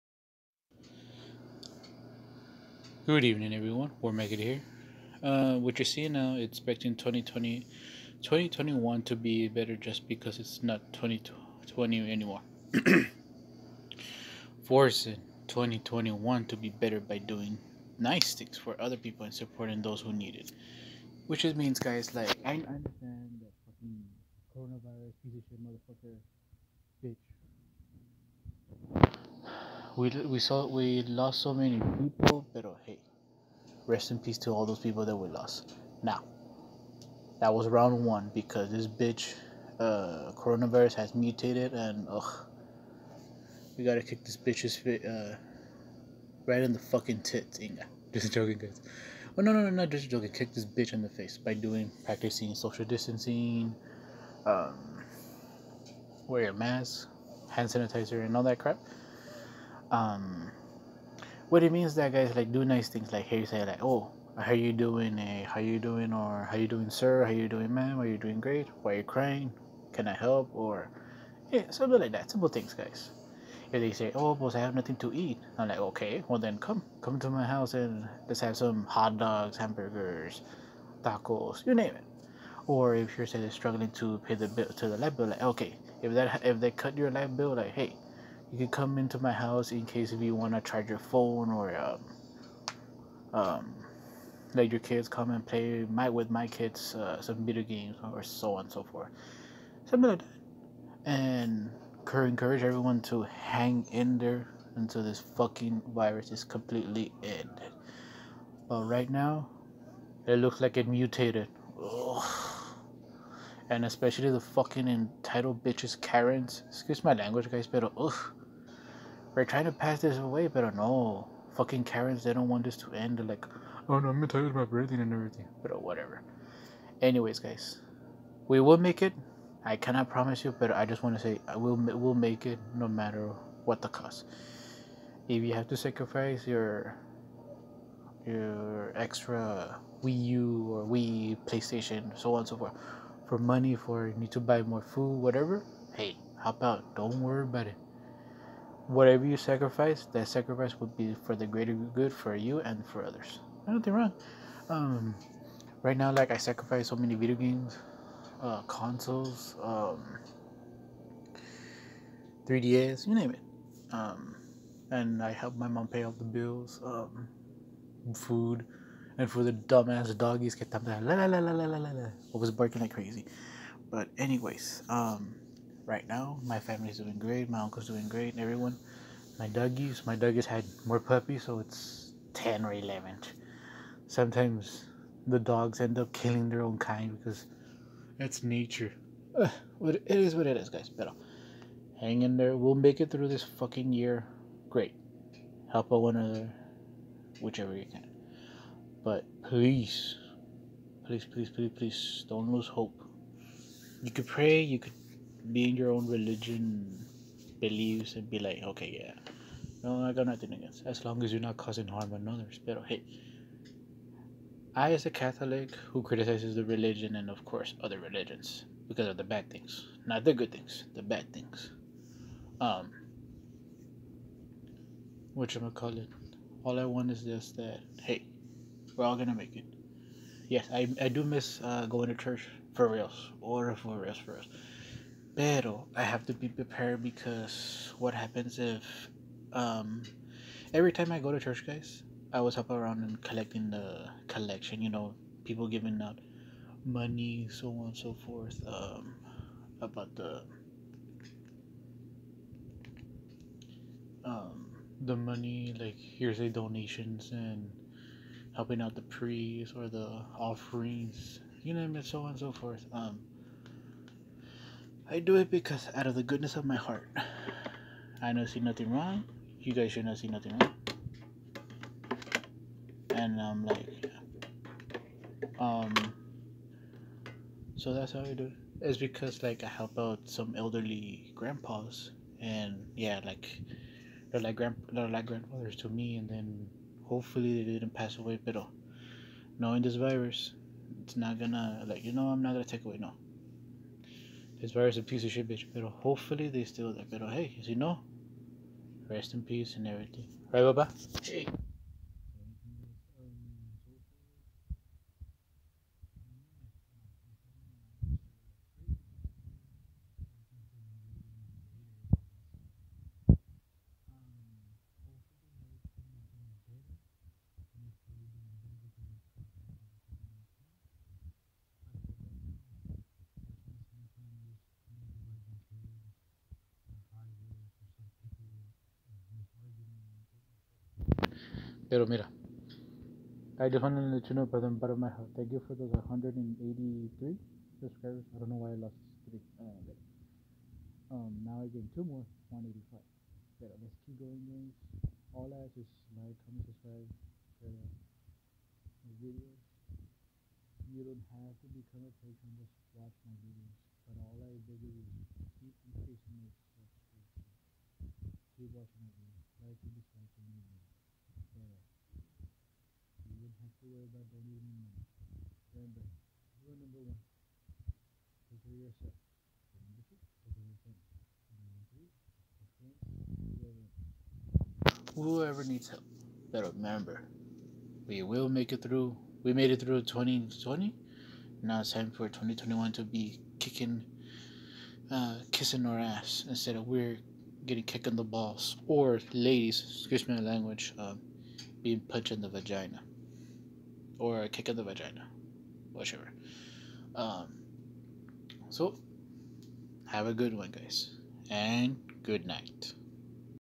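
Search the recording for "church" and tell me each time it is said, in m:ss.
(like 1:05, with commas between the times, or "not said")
3:52, 4:01.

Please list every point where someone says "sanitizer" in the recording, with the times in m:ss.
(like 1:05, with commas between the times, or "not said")
0:57.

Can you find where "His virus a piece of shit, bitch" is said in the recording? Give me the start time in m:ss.
4:54.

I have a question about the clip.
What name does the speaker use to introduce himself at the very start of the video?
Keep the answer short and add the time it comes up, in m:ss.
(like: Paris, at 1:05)
War Mega, at 0:03.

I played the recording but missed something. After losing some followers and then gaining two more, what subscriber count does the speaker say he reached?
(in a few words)
185.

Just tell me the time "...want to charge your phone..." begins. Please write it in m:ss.
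1:30.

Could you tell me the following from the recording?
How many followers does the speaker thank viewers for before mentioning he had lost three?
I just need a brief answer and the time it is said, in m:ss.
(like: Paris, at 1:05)
183, at 5:36.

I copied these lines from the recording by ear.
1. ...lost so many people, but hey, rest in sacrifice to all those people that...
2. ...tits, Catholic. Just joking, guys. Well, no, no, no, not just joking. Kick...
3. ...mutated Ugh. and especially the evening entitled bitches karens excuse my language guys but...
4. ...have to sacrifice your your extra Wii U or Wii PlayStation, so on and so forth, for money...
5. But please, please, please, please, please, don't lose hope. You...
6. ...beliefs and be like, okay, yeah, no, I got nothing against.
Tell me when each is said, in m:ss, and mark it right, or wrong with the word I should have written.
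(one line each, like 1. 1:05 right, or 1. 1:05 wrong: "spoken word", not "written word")
1. 0:31 wrong: "peace", not "sacrifice"
2. 0:47 wrong: "Inga", not "Catholic"
3. 1:50 wrong: "fucking", not "evening"
4. 2:15 right
5. 3:19 right
6. 3:27 right.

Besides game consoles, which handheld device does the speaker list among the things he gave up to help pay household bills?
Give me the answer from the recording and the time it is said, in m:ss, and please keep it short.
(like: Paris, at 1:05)
3DS, at 2:42.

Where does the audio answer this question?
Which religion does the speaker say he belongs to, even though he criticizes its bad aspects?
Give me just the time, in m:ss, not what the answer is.
3:35.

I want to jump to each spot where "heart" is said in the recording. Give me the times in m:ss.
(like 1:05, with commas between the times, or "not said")
4:26, 5:35.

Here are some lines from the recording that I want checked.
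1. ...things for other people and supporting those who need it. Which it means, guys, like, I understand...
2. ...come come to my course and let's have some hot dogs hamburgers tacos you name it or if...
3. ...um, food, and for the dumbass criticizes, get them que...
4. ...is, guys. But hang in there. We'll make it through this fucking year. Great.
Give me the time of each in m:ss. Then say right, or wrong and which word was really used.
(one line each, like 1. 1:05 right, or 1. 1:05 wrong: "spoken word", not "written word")
1. 0:18 right
2. 1:16 wrong: "house", not "course"
3. 2:46 wrong: "doggies", not "criticizes"
4. 3:10 right.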